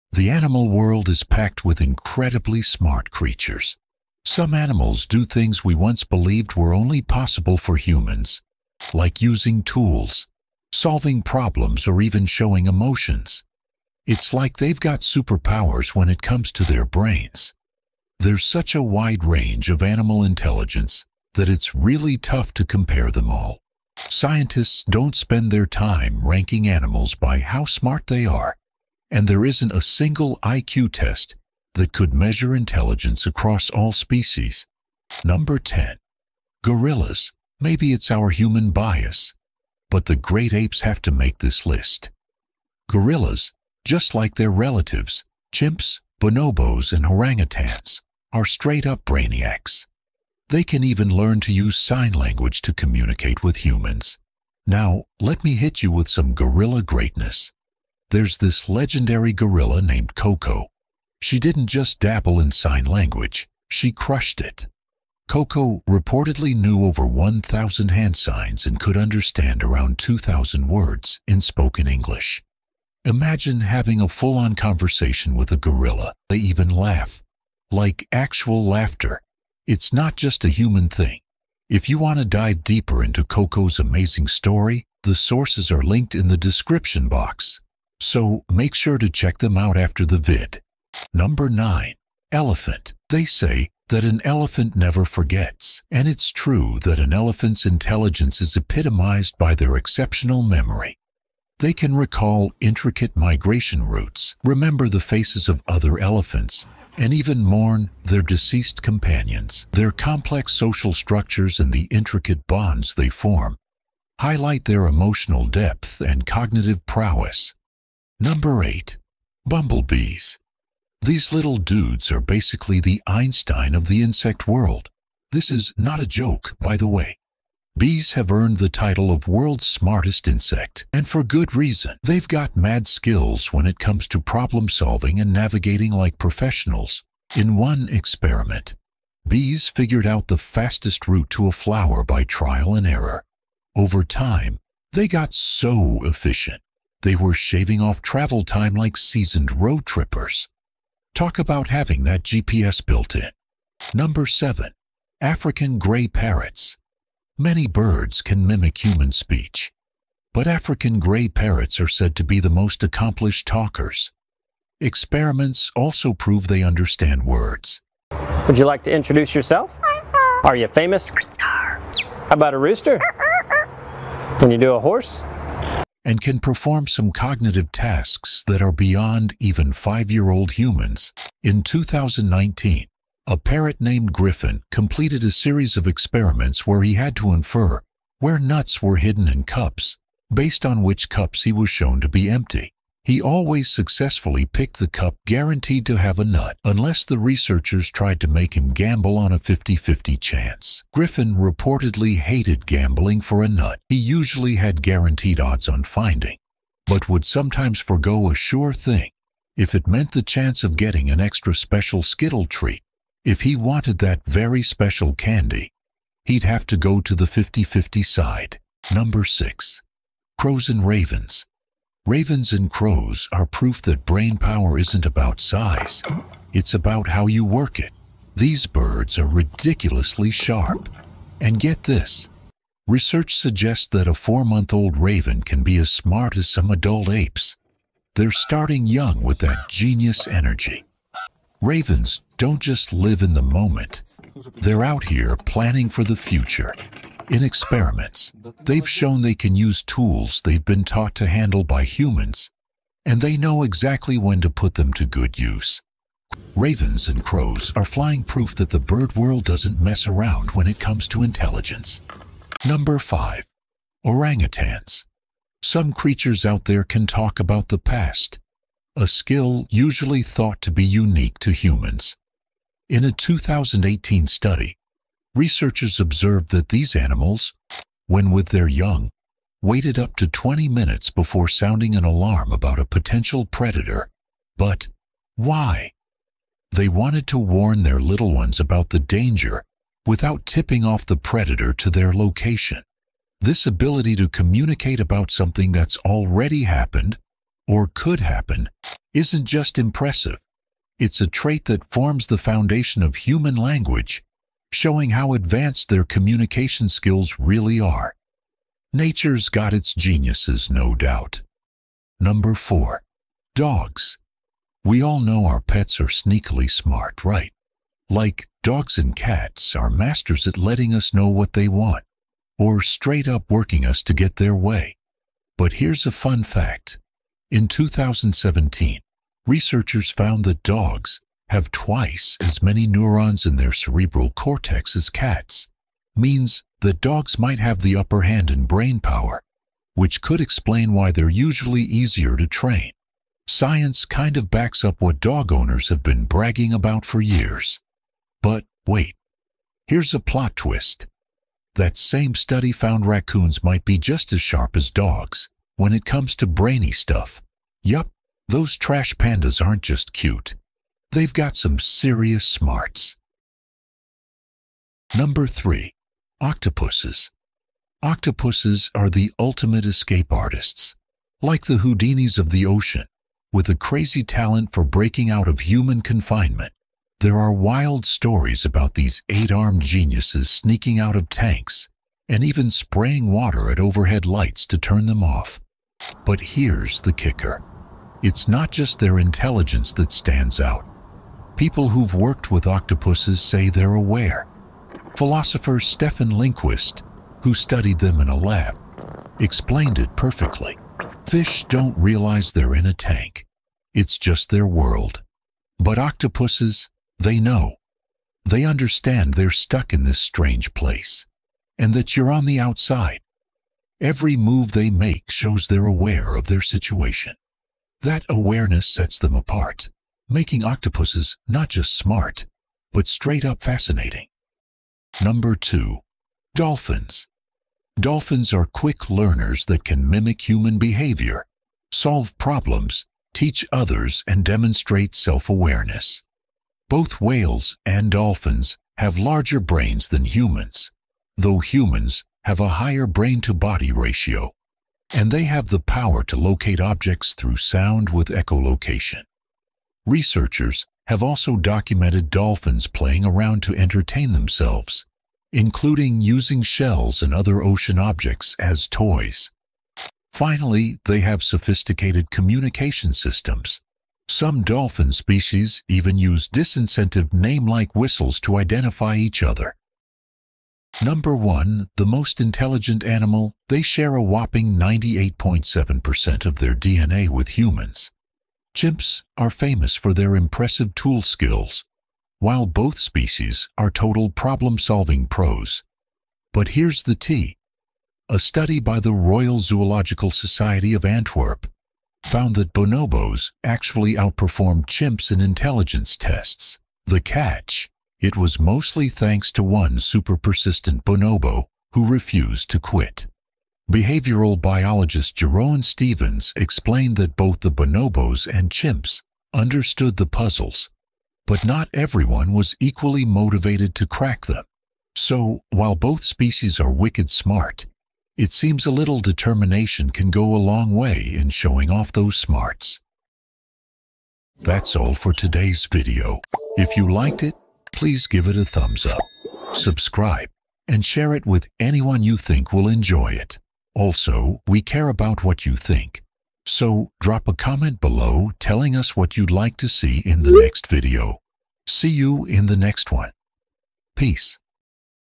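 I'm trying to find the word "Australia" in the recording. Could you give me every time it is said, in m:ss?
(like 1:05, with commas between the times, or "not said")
not said.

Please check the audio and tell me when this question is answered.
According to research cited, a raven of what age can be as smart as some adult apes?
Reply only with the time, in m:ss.
3:54.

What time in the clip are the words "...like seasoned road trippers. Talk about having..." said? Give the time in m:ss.
2:28.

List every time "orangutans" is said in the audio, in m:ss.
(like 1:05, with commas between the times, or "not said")
0:47, 4:24.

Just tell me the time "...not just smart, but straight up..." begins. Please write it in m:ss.
7:01.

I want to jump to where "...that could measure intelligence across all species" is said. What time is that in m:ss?
0:31.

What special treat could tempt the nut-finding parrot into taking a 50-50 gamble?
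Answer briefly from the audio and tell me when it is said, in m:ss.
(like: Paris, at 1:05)
Skittle, at 3:32.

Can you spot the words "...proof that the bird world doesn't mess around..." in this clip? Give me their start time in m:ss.
4:18.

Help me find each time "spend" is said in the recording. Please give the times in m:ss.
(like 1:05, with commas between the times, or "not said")
0:25.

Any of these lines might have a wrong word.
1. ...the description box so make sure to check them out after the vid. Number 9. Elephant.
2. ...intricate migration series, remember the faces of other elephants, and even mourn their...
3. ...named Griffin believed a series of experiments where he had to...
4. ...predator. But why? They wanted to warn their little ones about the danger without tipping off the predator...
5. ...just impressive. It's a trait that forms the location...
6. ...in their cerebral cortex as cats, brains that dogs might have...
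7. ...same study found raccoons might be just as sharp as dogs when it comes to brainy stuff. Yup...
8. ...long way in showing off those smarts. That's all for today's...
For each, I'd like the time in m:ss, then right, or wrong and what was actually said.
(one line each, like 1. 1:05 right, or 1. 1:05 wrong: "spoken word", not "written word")
1. 1:26 right
2. 1:42 wrong: "routes", not "series"
3. 3:03 wrong: "completed", not "believed"
4. 4:43 right
5. 4:59 wrong: "foundation", not "location"
6. 5:33 wrong: "means", not "brains"
7. 5:51 right
8. 8:40 right.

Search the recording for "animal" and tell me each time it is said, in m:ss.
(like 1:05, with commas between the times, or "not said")
0:00, 0:04, 0:19, 0:26, 4:36, 7:53.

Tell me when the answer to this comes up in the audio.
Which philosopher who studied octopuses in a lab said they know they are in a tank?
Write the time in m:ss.
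6:35.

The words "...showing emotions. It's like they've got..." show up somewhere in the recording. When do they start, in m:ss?
0:12.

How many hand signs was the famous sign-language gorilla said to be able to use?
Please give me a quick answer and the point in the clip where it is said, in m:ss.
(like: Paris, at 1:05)
over 1,000, at 1:06.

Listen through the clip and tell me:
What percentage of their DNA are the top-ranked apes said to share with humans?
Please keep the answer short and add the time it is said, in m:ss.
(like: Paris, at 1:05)
98.7%, at 7:54.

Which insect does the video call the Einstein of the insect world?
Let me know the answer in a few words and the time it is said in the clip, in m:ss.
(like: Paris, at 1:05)
Bumblebees, at 1:59.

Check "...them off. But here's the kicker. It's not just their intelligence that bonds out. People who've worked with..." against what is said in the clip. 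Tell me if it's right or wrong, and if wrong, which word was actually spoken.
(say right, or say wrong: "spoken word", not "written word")
wrong: "stands", not "bonds".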